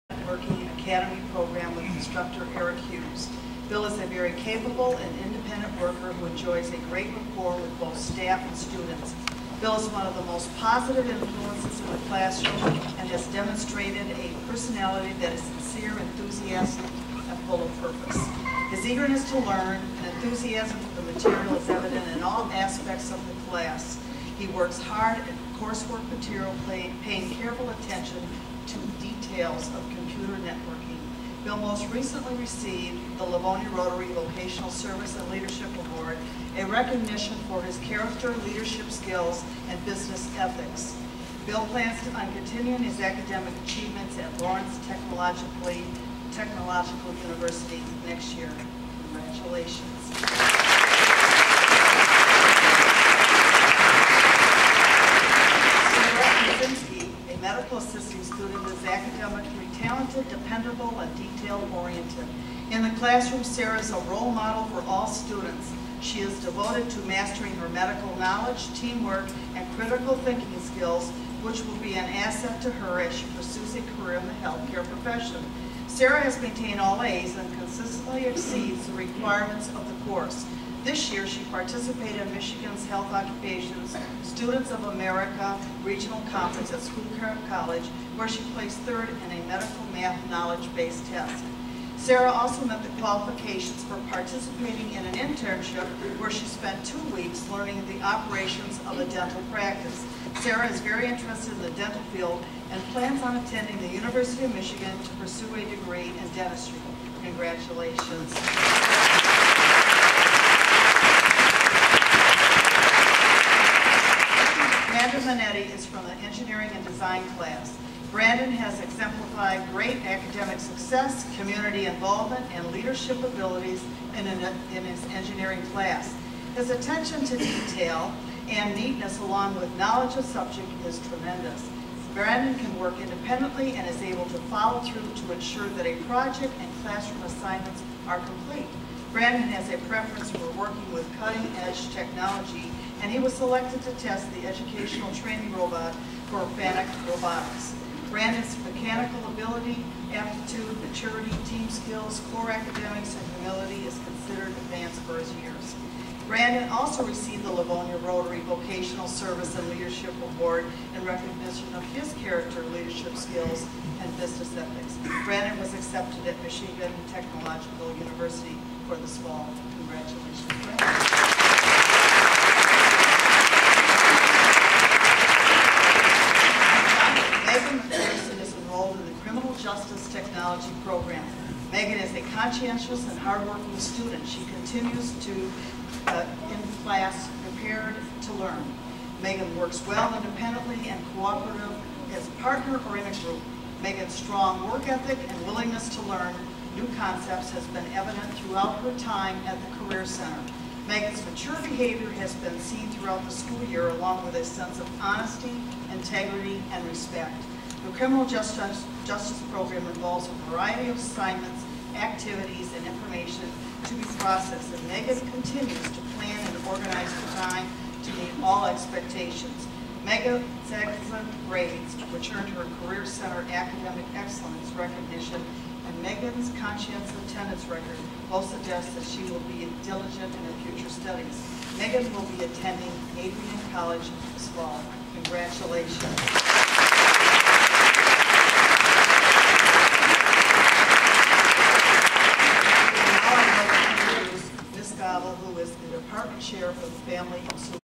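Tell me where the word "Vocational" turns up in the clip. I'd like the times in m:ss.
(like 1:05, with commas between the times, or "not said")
0:34, 2:38.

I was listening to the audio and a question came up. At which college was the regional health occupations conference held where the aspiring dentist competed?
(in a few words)
Schoolcraft College.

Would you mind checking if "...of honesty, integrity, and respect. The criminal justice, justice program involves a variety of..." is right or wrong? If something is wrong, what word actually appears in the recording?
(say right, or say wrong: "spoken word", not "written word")
right.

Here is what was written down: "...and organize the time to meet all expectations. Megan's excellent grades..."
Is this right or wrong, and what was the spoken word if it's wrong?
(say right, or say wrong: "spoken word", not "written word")
right.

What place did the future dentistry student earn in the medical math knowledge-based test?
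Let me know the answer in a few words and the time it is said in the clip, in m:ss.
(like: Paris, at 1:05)
third, at 1:28.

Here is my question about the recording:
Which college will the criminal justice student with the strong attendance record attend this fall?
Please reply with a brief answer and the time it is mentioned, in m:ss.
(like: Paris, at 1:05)
Adrian College, at 3:53.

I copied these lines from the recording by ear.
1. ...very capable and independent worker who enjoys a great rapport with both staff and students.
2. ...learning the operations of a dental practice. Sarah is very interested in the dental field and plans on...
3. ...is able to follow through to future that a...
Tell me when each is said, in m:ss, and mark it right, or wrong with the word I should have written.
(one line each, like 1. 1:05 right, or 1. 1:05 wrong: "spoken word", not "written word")
1. 0:04 right
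2. 1:37 right
3. 2:13 wrong: "ensure", not "future".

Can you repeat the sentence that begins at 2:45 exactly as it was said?
Brandon was accepted at Michigan Technological University for this fall.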